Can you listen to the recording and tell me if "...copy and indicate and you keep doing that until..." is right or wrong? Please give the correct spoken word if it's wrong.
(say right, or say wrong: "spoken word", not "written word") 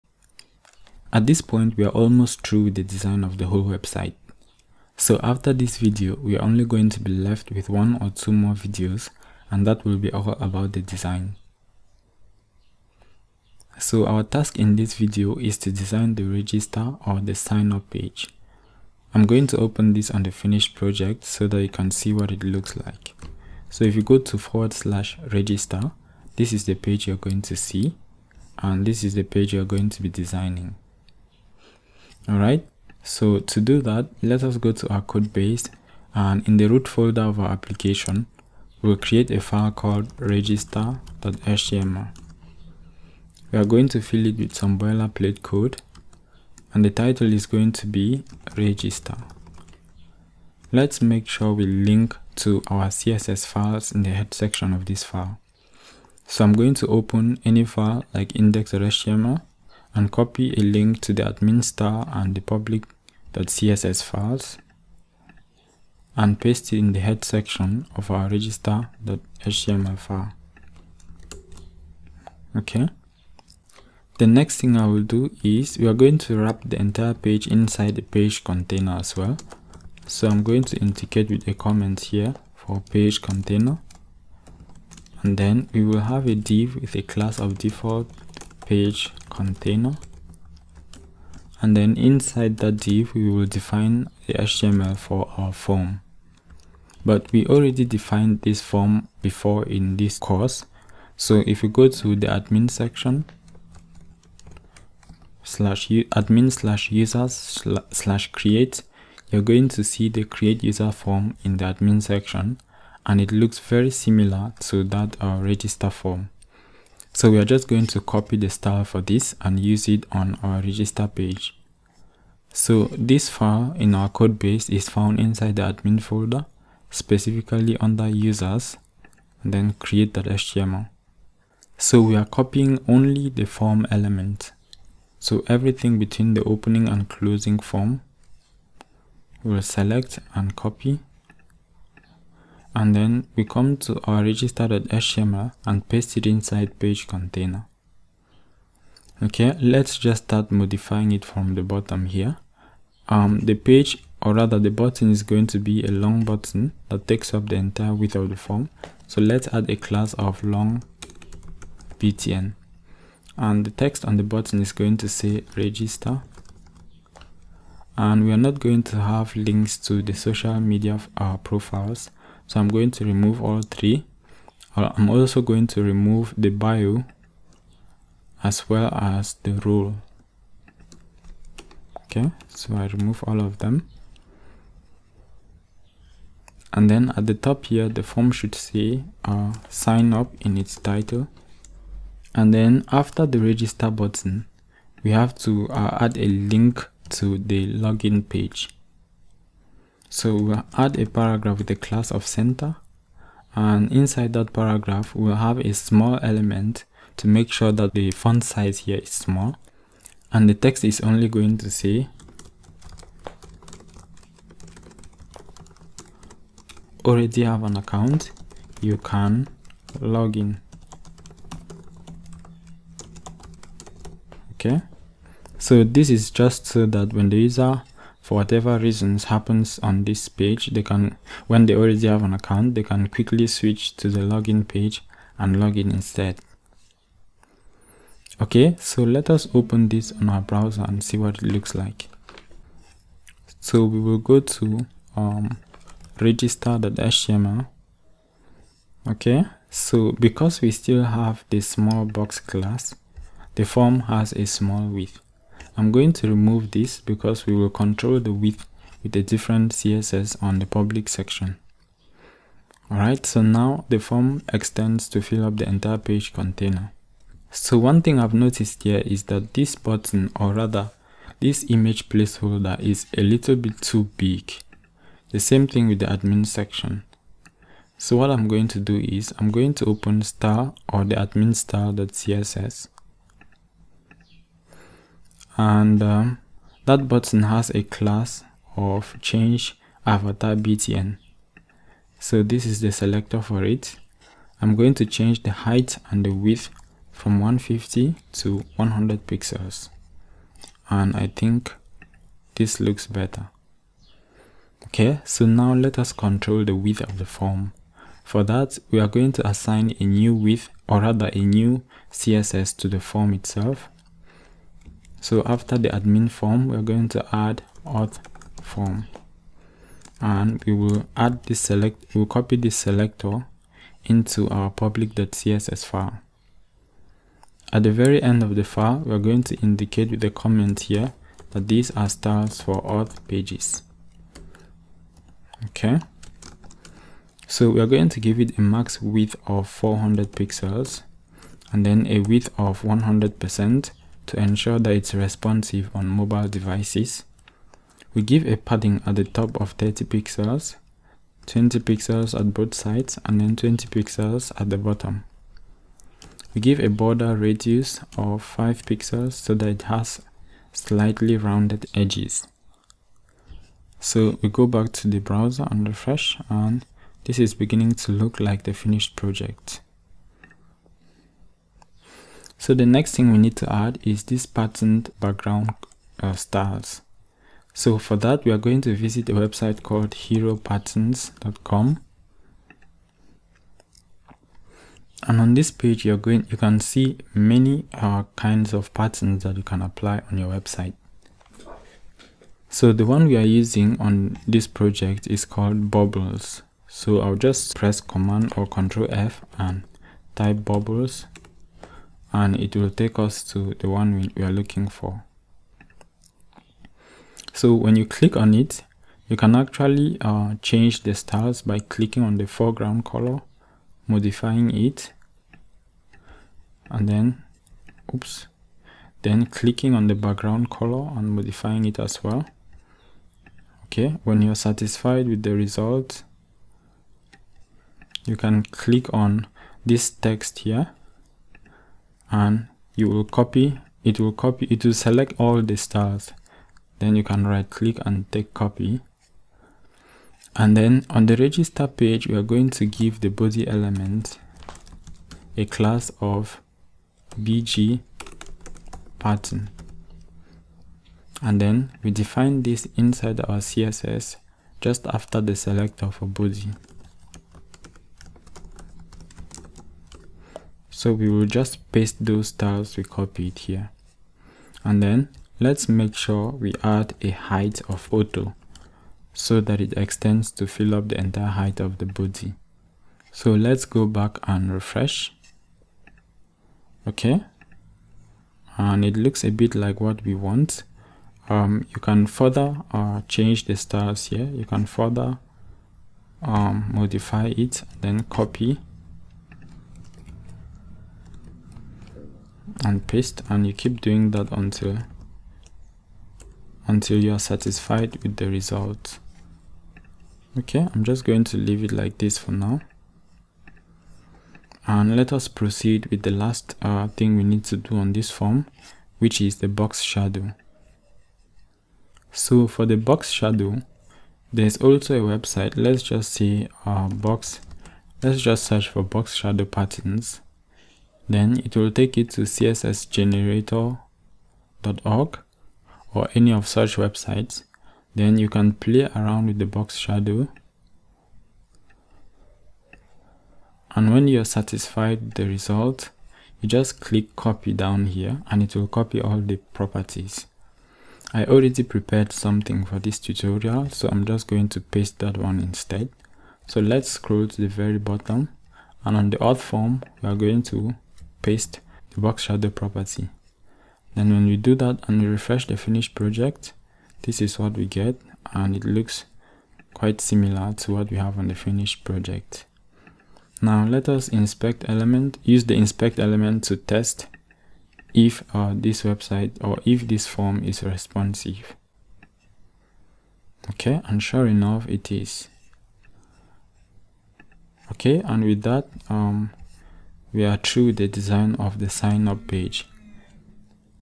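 wrong: "paste", not "indicate".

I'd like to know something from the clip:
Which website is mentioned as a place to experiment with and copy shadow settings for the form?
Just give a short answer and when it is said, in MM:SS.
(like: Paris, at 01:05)
cssgenerator.org, at 08:42.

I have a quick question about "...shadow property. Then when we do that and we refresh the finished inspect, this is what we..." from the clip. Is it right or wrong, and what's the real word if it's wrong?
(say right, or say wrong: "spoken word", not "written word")
wrong: "project", not "inspect".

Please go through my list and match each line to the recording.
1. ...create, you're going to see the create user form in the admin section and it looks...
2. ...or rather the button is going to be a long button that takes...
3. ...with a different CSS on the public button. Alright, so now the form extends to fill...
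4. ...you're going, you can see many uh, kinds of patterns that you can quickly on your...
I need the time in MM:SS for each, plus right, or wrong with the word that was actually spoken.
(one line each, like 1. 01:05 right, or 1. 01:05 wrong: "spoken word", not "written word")
1. 01:48 right
2. 02:34 right
3. 04:19 wrong: "section", not "button"
4. 06:26 wrong: "apply", not "quickly".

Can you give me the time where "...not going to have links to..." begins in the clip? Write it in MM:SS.
02:48.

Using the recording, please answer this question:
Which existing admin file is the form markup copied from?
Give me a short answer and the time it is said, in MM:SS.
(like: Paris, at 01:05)
create.html, at 02:09.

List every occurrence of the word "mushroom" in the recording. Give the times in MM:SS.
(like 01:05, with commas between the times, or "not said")
not said.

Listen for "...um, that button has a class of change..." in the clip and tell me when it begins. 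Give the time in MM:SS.
04:46.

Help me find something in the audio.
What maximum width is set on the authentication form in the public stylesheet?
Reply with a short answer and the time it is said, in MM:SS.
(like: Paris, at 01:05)
400 pixels, at 05:39.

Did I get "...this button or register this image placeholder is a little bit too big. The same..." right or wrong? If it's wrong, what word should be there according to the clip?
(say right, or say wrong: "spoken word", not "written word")
wrong: "rather", not "register".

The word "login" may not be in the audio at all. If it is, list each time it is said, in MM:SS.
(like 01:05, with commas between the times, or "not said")
03:17, 03:54.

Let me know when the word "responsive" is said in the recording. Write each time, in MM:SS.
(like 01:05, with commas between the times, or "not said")
05:45, 09:30.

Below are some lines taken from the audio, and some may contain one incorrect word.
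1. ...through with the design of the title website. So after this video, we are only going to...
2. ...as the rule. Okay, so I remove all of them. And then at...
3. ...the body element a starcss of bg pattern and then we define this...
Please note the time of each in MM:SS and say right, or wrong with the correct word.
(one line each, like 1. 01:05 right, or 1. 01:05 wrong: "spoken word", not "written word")
1. 00:02 wrong: "whole", not "title"
2. 02:58 right
3. 07:23 wrong: "class", not "starcss".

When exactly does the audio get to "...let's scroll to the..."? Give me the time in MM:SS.
09:06.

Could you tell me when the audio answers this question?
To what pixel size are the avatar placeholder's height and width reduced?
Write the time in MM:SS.
04:58.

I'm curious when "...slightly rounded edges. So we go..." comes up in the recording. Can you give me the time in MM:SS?
06:00.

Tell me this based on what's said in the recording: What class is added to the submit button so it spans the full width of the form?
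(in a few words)
long btn.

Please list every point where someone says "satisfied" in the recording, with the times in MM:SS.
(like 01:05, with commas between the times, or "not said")
07:04, 08:17, 08:54.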